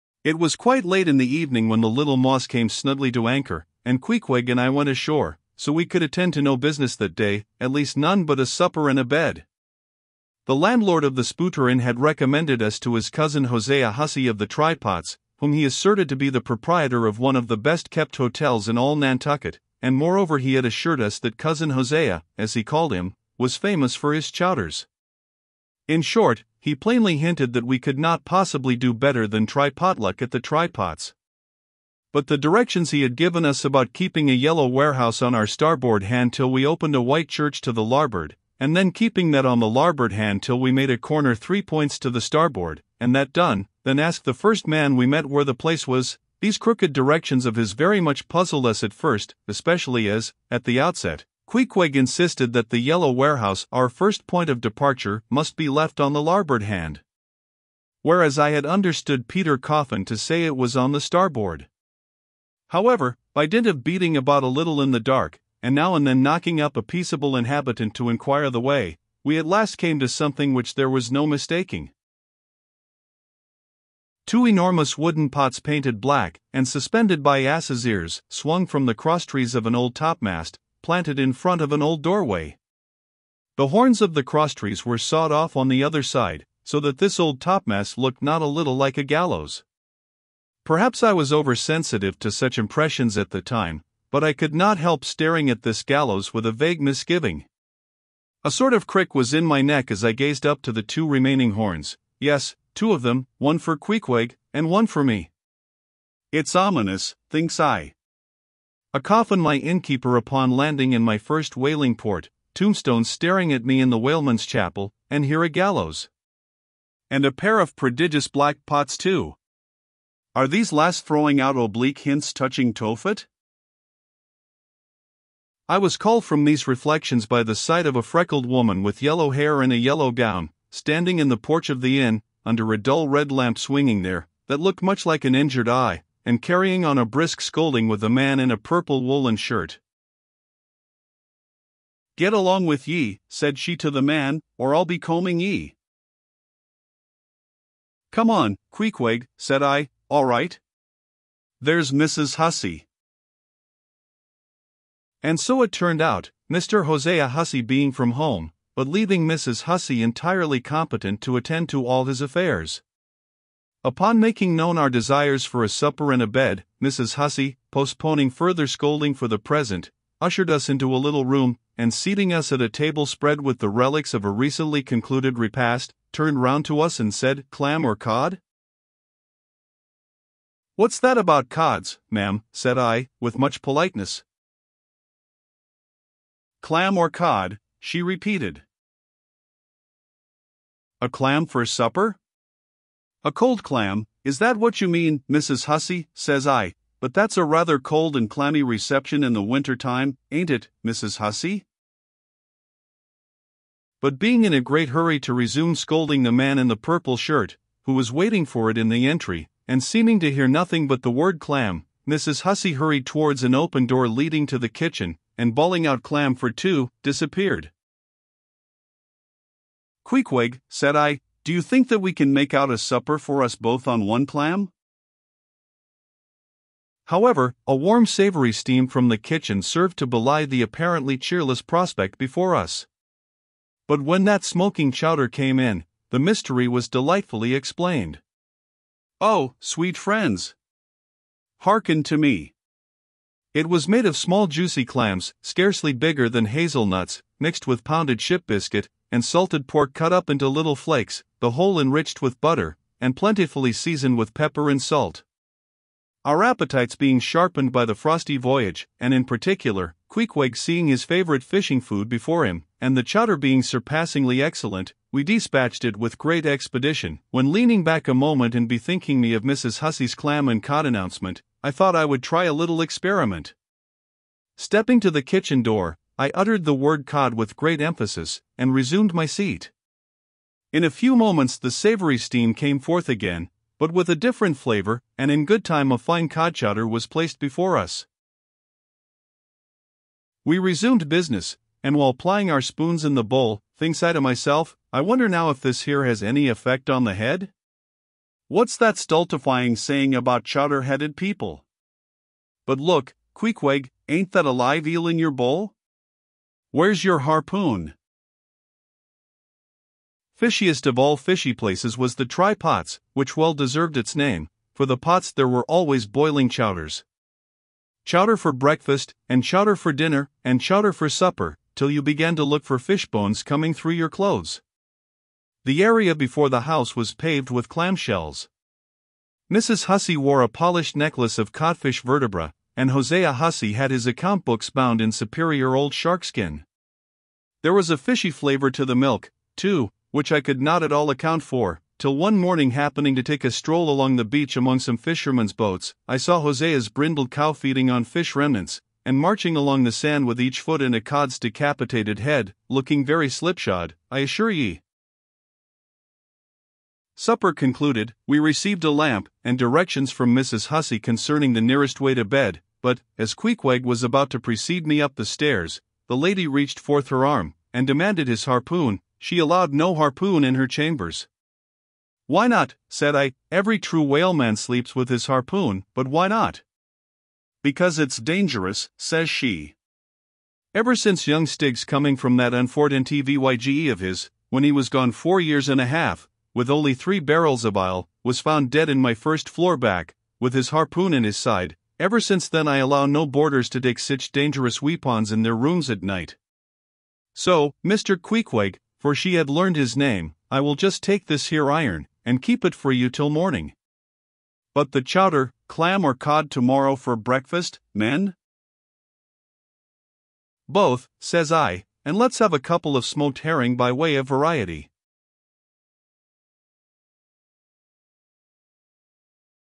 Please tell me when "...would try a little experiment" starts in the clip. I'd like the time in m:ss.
4:32.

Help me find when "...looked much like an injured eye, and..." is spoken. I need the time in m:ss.
2:14.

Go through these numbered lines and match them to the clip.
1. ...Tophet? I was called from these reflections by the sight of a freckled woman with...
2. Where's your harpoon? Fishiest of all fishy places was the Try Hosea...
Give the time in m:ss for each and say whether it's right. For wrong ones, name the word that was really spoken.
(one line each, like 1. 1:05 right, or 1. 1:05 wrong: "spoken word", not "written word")
1. 2:02 right
2. 5:06 wrong: "Pots", not "Hosea".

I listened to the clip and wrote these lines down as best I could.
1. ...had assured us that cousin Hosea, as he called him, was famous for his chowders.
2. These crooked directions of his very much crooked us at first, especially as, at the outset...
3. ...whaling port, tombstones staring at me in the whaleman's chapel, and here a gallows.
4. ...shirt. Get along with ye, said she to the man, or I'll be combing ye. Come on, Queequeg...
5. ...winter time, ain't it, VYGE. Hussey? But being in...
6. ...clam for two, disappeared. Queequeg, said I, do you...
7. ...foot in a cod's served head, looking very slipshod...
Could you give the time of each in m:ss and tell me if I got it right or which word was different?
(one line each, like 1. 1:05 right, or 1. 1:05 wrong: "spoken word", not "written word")
1. 0:20 right
2. 0:46 wrong: "puzzled", not "crooked"
3. 1:51 right
4. 2:19 right
5. 3:19 wrong: "Mrs", not "VYGE"
6. 3:36 right
7. 5:50 wrong: "decapitated", not "served".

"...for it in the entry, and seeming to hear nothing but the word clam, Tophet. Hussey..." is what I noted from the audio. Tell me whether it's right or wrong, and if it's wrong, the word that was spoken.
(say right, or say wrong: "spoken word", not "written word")
wrong: "Mrs", not "Tophet".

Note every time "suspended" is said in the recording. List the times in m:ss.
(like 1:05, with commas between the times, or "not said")
1:16.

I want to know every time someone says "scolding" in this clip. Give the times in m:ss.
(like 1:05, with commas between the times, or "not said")
2:17, 2:48, 3:25.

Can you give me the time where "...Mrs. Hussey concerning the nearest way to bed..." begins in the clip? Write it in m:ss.
6:00.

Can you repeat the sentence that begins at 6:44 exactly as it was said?
But the chowder, clam or cod tomorrow for breakfast, men?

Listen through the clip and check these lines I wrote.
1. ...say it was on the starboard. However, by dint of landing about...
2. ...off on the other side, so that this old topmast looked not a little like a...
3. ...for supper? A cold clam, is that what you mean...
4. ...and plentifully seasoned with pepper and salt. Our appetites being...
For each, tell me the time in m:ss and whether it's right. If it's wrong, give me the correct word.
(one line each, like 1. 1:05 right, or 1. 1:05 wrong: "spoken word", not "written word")
1. 1:00 wrong: "beating", not "landing"
2. 1:25 right
3. 3:11 right
4. 4:13 right.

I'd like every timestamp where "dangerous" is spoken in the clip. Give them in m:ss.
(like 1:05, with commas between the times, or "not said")
6:18, 6:34.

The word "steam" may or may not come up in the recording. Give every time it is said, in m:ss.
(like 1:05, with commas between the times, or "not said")
3:48, 4:42.